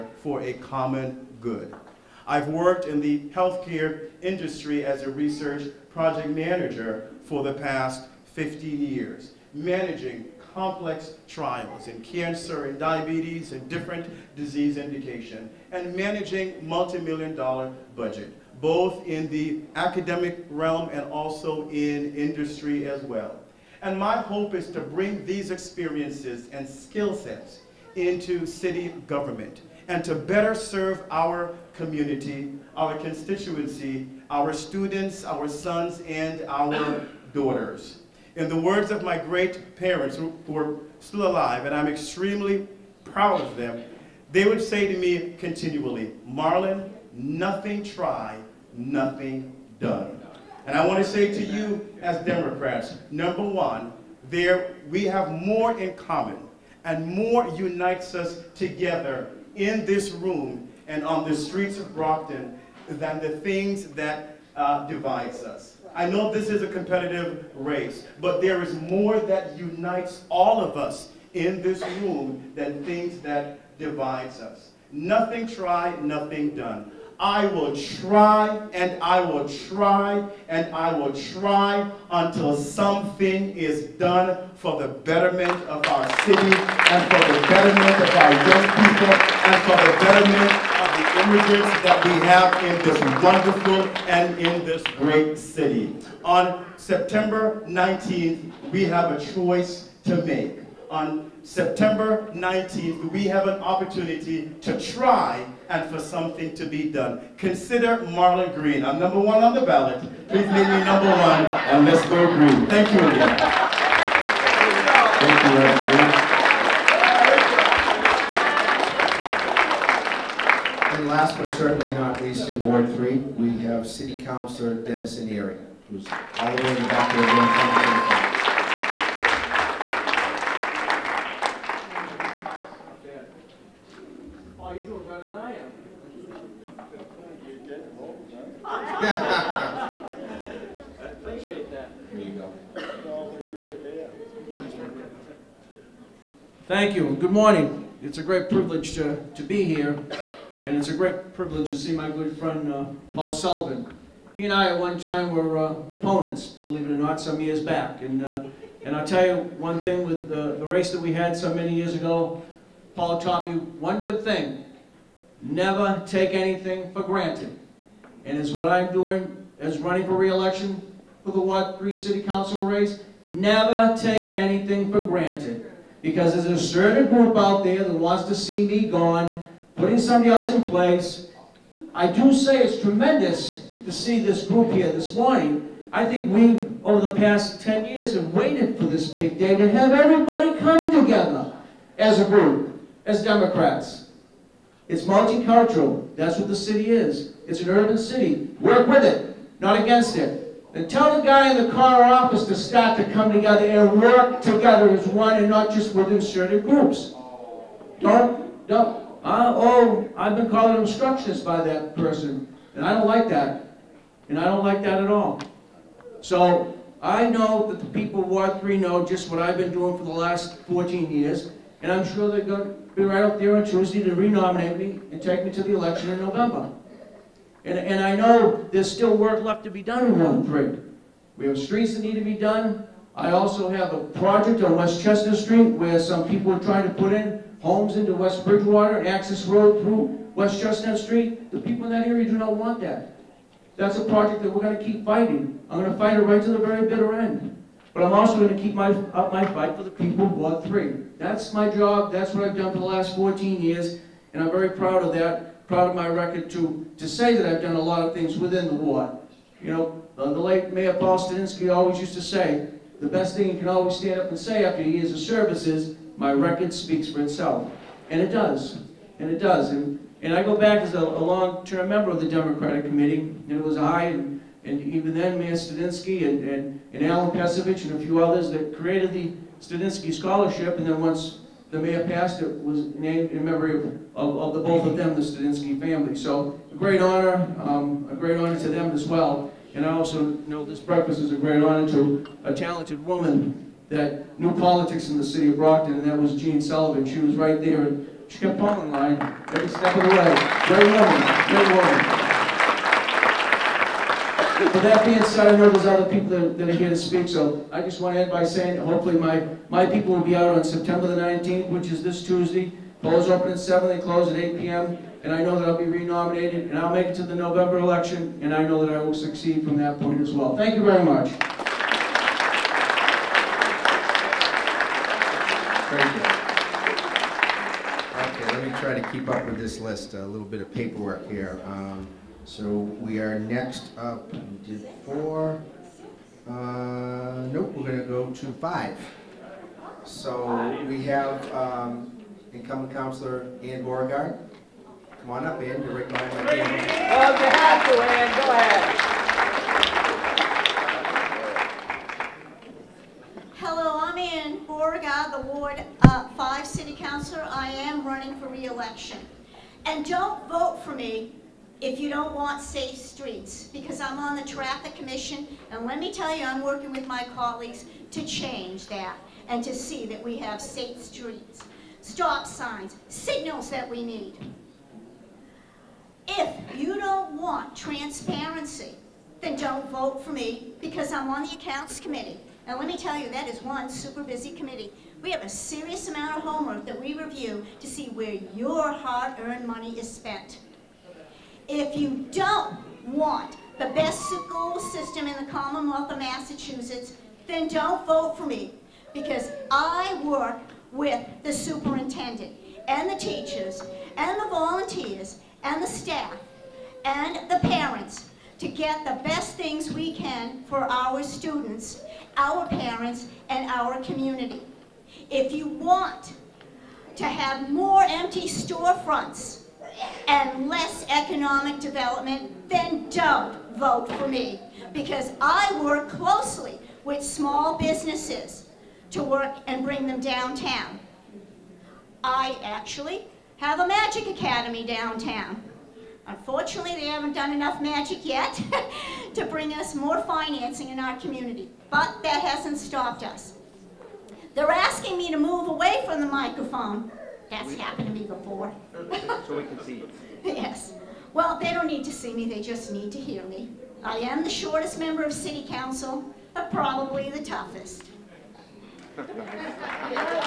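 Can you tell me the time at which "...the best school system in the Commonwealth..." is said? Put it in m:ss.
6:33.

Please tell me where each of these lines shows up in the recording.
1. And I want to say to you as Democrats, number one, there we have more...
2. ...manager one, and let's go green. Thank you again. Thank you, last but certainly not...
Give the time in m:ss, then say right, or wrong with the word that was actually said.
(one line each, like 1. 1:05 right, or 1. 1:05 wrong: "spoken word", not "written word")
1. 0:50 right
2. 1:50 wrong: "number", not "manager".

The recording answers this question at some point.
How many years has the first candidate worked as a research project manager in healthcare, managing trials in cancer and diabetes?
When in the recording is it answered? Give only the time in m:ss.
0:08.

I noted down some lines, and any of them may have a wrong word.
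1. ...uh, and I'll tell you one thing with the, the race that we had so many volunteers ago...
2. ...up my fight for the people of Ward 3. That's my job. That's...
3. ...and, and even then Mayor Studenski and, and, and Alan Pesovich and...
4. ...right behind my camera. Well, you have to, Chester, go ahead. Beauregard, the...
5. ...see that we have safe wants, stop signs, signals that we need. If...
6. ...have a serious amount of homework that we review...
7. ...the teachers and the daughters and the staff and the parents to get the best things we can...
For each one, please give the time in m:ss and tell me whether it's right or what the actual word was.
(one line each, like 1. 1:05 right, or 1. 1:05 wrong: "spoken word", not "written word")
1. 2:38 wrong: "years", not "volunteers"
2. 4:09 right
3. 4:34 right
4. 5:45 wrong: "Ann", not "Chester"
5. 6:09 wrong: "streets", not "wants"
6. 6:25 right
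7. 6:43 wrong: "volunteers", not "daughters".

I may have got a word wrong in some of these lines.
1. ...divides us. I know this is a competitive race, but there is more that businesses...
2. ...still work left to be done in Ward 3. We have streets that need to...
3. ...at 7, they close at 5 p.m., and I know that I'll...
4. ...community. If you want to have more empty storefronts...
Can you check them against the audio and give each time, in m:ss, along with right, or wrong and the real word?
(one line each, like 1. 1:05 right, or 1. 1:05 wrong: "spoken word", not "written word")
1. 1:04 wrong: "unites", not "businesses"
2. 3:48 right
3. 5:13 wrong: "8", not "5"
4. 6:54 right.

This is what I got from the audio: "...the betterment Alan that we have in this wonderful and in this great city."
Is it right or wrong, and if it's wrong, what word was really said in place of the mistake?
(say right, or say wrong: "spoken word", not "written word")
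wrong: "Immigrants", not "Alan".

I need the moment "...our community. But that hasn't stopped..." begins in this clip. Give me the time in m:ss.
7:21.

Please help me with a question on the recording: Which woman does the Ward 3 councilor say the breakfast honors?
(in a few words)
Jean Sullivan.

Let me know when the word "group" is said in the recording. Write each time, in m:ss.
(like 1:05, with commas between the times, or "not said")
2:57, 3:04, 3:12, 3:26.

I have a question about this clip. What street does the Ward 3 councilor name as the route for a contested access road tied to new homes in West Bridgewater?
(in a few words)
West Chestnut Street.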